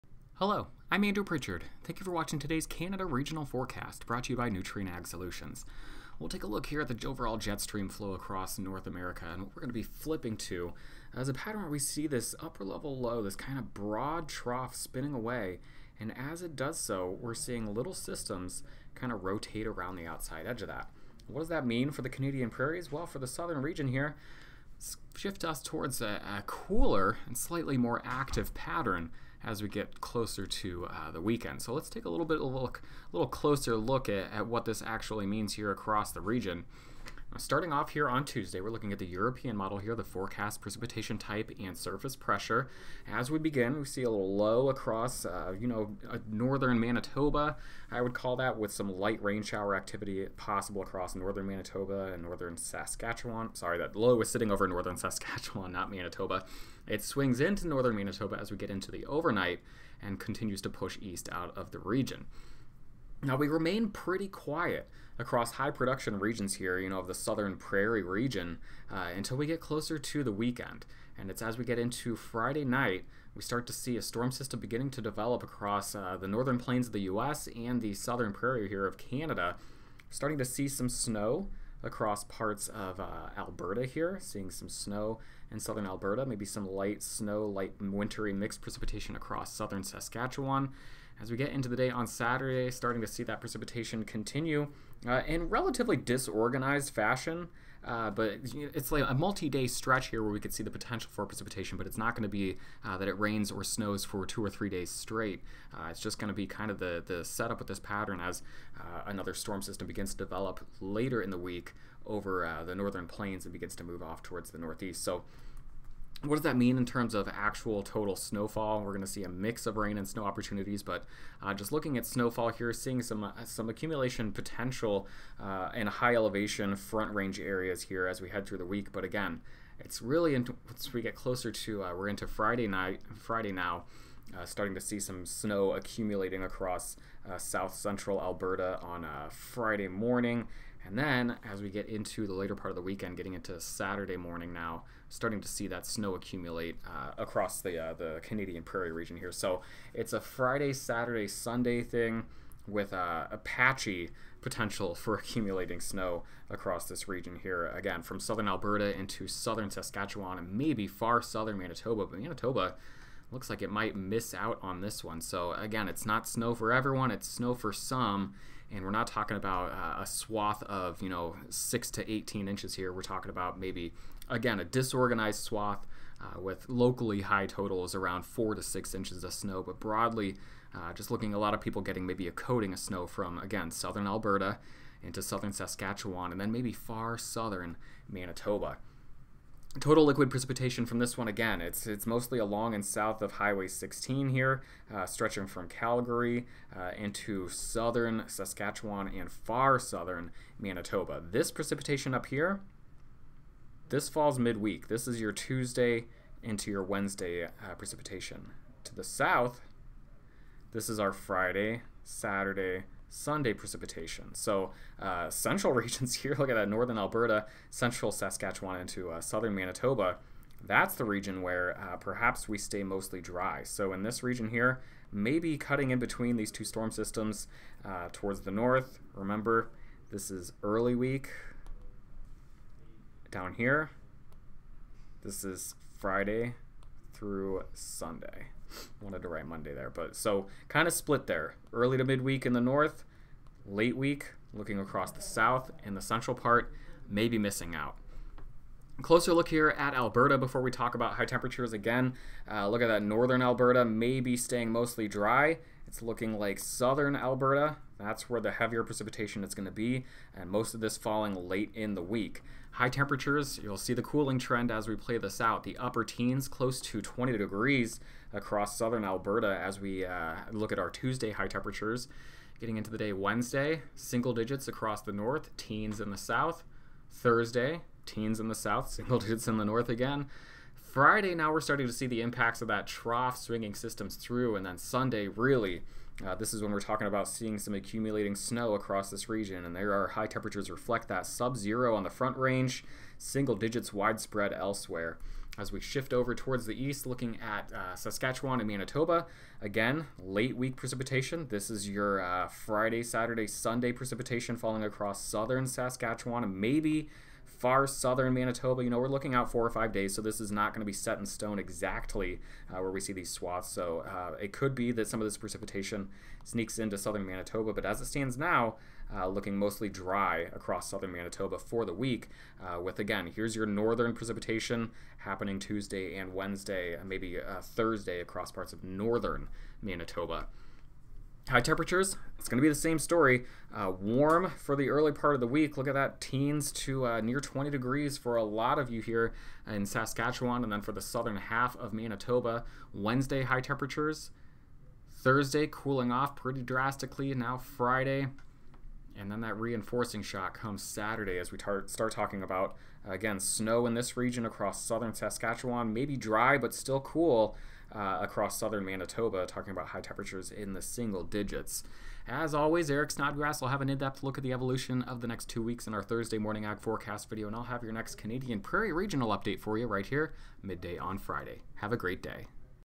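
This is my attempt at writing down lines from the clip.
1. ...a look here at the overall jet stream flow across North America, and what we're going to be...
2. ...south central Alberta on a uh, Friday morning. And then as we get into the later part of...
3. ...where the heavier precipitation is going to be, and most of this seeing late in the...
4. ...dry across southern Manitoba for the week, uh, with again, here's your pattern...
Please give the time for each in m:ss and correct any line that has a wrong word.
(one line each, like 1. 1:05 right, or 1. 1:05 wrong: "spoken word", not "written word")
1. 0:06 right
2. 2:17 right
3. 4:18 wrong: "falling", not "seeing"
4. 5:19 wrong: "northern", not "pattern".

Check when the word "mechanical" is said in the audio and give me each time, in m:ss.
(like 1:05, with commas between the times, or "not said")
not said.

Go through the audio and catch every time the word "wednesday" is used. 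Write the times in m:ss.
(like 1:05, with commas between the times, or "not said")
3:26, 4:33, 5:26, 5:42.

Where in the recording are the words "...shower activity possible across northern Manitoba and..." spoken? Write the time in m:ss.
0:49.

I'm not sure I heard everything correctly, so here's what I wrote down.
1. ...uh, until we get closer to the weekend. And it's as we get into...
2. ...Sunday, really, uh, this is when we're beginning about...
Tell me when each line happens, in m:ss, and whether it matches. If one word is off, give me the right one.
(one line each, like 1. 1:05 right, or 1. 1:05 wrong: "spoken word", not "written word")
1. 1:08 right
2. 4:44 wrong: "talking", not "beginning".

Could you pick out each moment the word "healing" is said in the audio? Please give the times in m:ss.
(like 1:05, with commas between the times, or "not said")
not said.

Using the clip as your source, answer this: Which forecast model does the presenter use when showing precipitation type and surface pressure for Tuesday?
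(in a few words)
European model.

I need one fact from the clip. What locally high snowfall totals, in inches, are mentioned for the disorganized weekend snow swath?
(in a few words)
4 to 6 inches.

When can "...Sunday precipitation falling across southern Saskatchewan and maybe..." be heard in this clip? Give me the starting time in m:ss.
5:03.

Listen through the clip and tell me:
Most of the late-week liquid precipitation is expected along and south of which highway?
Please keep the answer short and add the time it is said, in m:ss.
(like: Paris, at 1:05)
Highway 16, at 3:13.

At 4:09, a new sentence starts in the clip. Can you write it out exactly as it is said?
Closer look here at Alberta before we talk about high temperatures again.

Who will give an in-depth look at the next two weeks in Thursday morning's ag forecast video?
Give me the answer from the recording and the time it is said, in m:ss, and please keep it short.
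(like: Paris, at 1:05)
Eric Snodgrass, at 6:02.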